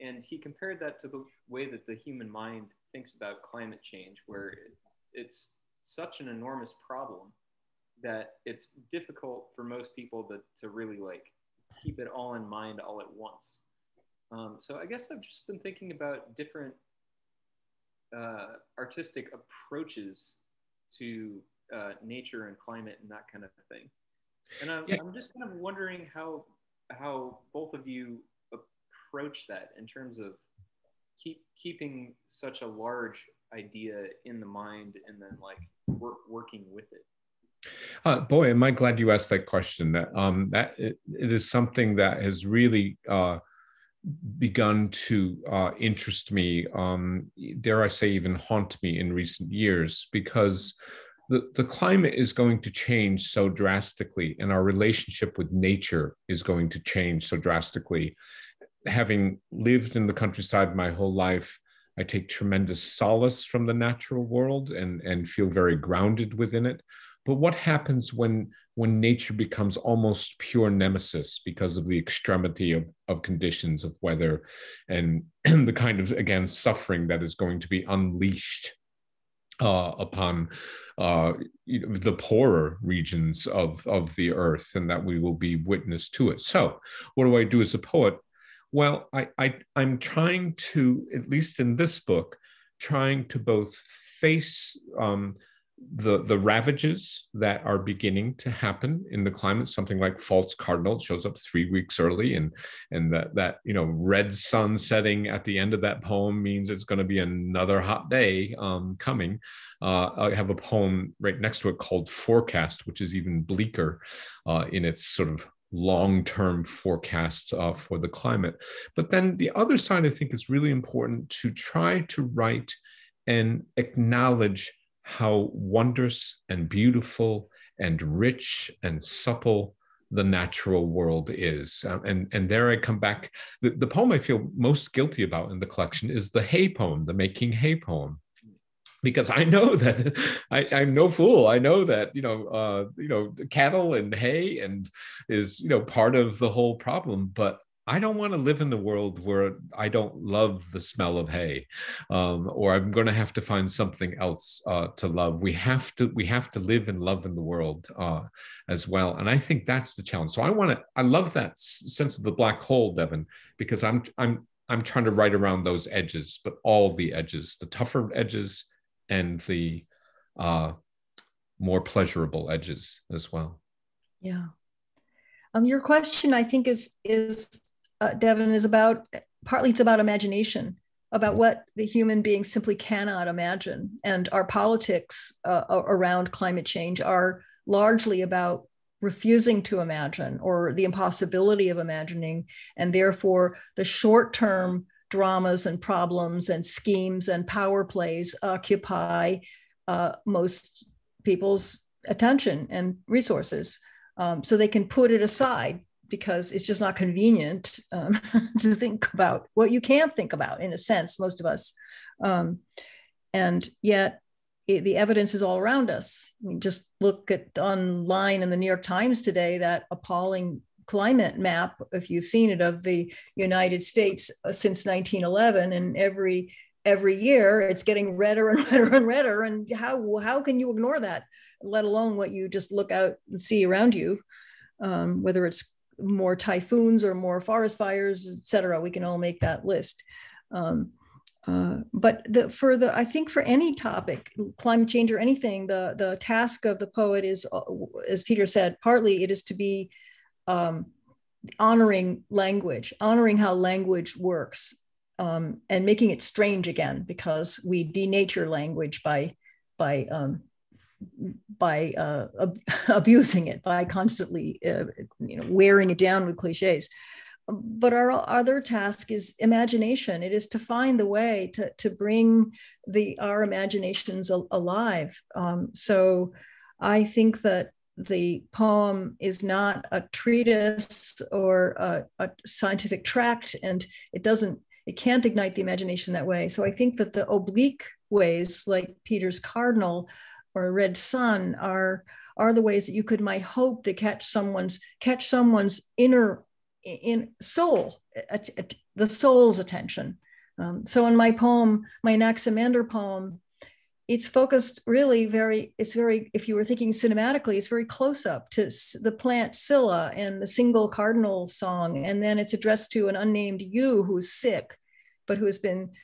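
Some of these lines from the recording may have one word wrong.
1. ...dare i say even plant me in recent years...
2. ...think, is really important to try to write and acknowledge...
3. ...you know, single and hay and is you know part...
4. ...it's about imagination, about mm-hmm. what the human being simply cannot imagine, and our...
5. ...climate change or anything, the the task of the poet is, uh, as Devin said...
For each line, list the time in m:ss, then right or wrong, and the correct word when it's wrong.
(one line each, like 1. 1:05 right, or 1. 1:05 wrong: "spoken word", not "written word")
1. 0:47 wrong: "haunt", not "plant"
2. 2:00 right
3. 2:22 wrong: "cattle", not "single"
4. 2:59 right
5. 4:04 wrong: "Peter", not "Devin".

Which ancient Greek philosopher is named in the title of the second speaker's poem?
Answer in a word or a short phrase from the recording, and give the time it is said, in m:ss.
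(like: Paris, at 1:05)
Anaximander, at 5:02.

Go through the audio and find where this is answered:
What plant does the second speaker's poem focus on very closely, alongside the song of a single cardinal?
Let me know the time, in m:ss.
5:09.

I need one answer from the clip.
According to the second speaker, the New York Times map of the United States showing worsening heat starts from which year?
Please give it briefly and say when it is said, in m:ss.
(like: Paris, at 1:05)
1911, at 3:44.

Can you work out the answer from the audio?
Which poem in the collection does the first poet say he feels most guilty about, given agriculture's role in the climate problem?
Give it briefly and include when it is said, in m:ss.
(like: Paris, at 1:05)
Making Hay, at 2:17.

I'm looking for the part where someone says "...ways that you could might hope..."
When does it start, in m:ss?
4:52.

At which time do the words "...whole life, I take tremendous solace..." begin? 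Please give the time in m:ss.
1:00.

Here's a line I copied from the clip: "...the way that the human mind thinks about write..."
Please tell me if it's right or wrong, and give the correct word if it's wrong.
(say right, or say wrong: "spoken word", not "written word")
wrong: "climate", not "write".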